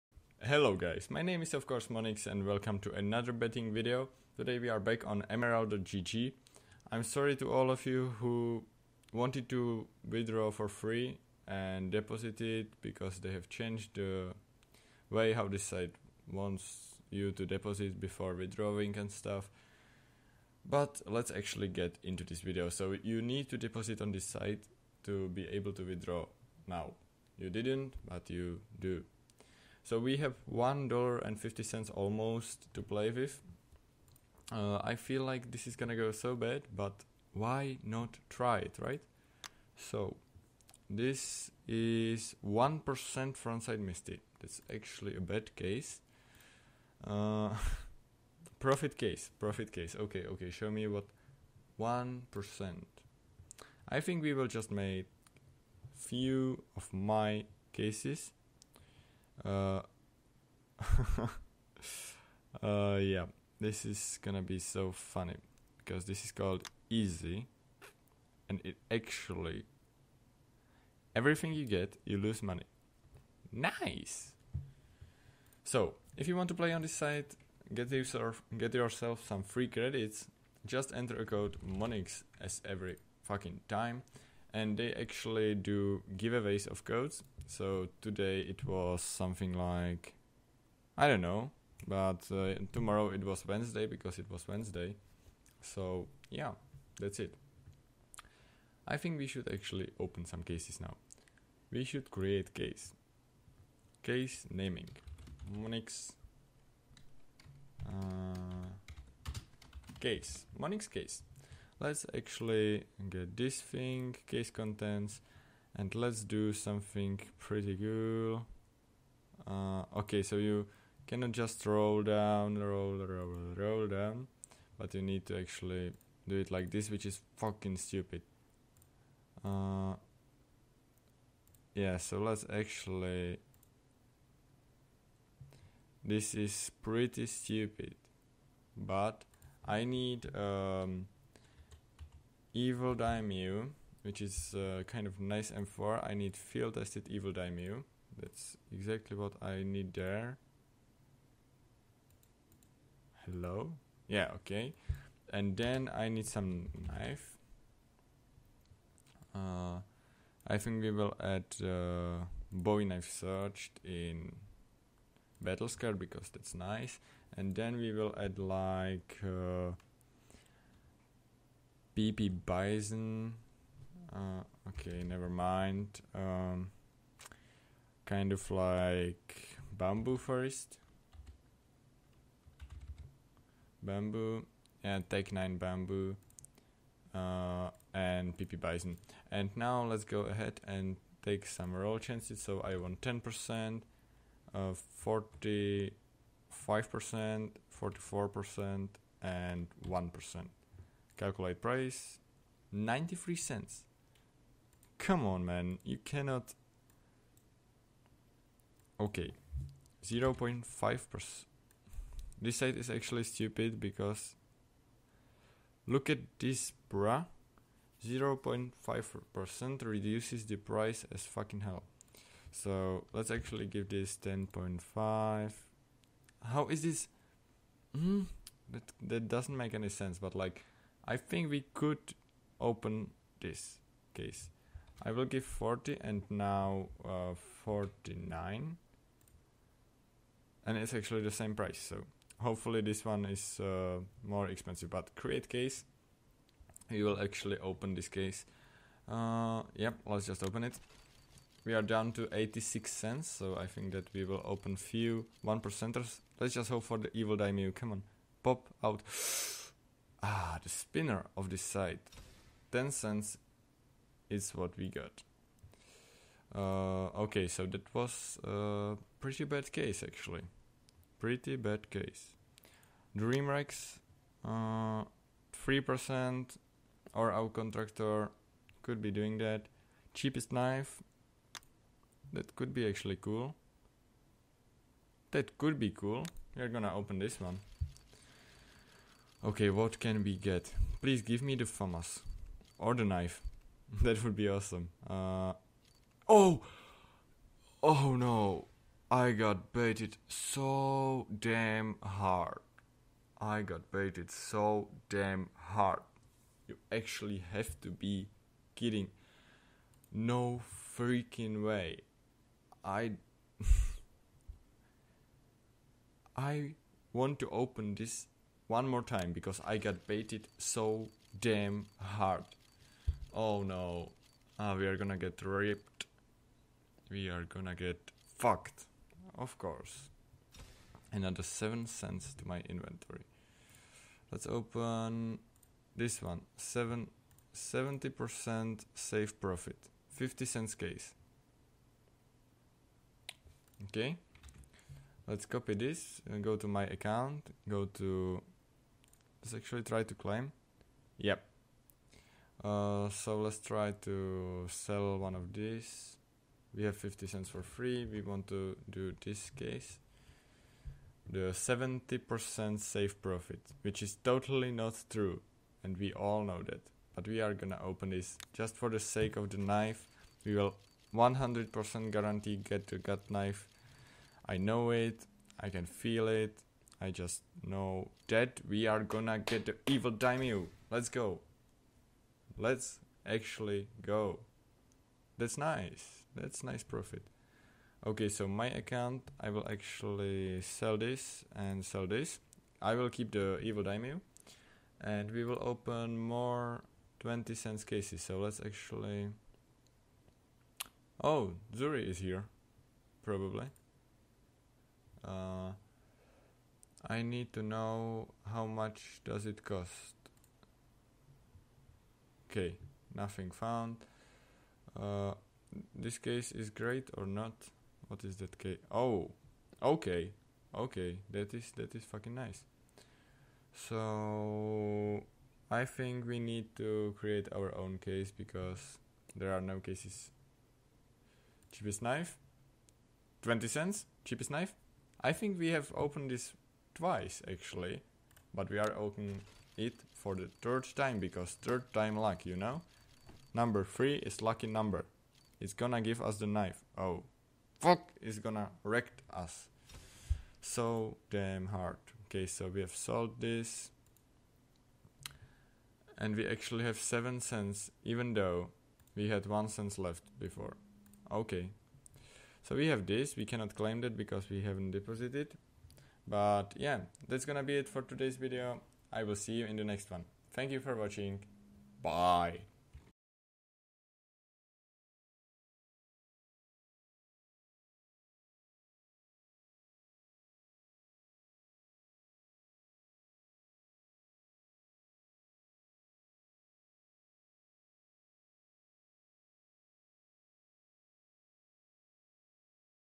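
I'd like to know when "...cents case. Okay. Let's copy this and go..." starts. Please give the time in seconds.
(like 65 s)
340 s.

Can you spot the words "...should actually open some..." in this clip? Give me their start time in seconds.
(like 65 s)
99 s.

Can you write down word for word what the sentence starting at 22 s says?
So you need to deposit on this site to be able to withdraw now.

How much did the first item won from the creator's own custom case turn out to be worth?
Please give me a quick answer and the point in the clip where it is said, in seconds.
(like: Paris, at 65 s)
10 cents, at 262 s.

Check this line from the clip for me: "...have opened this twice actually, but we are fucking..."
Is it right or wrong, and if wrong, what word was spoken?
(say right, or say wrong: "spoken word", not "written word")
wrong: "opening", not "fucking".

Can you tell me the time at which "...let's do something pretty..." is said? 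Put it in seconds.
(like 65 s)
115 s.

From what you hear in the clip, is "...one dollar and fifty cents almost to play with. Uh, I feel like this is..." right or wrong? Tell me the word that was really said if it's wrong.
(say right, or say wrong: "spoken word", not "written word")
right.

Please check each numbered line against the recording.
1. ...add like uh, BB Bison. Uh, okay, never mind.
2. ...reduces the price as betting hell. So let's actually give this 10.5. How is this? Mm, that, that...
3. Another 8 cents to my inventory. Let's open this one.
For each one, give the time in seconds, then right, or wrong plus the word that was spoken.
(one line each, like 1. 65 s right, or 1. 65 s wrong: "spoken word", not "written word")
1. 168 s right
2. 219 s wrong: "fucking", not "betting"
3. 331 s wrong: "7", not "8".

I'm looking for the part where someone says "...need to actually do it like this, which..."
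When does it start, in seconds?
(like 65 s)
125 s.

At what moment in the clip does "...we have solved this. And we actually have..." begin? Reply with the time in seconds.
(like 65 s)
452 s.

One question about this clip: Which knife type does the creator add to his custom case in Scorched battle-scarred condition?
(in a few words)
Bowie knife.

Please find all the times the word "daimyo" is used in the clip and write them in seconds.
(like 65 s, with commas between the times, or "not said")
142 s, 147 s, 257 s, 380 s, 393 s.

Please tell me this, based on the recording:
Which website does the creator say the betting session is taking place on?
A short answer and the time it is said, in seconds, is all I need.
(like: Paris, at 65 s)
emerald.gg, at 5 s.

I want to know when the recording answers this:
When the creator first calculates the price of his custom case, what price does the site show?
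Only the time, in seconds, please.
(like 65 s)
202 s.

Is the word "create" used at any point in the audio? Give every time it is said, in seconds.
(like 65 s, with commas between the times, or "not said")
102 s, 245 s, 427 s.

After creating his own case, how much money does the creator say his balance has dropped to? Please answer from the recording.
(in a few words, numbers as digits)
86 cents.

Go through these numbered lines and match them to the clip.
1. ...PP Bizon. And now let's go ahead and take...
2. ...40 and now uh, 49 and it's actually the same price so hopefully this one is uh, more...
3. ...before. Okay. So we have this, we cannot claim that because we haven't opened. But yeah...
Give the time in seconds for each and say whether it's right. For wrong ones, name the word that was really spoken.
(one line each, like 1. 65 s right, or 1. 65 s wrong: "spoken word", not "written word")
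1. 188 s right
2. 235 s right
3. 460 s wrong: "deposited", not "opened".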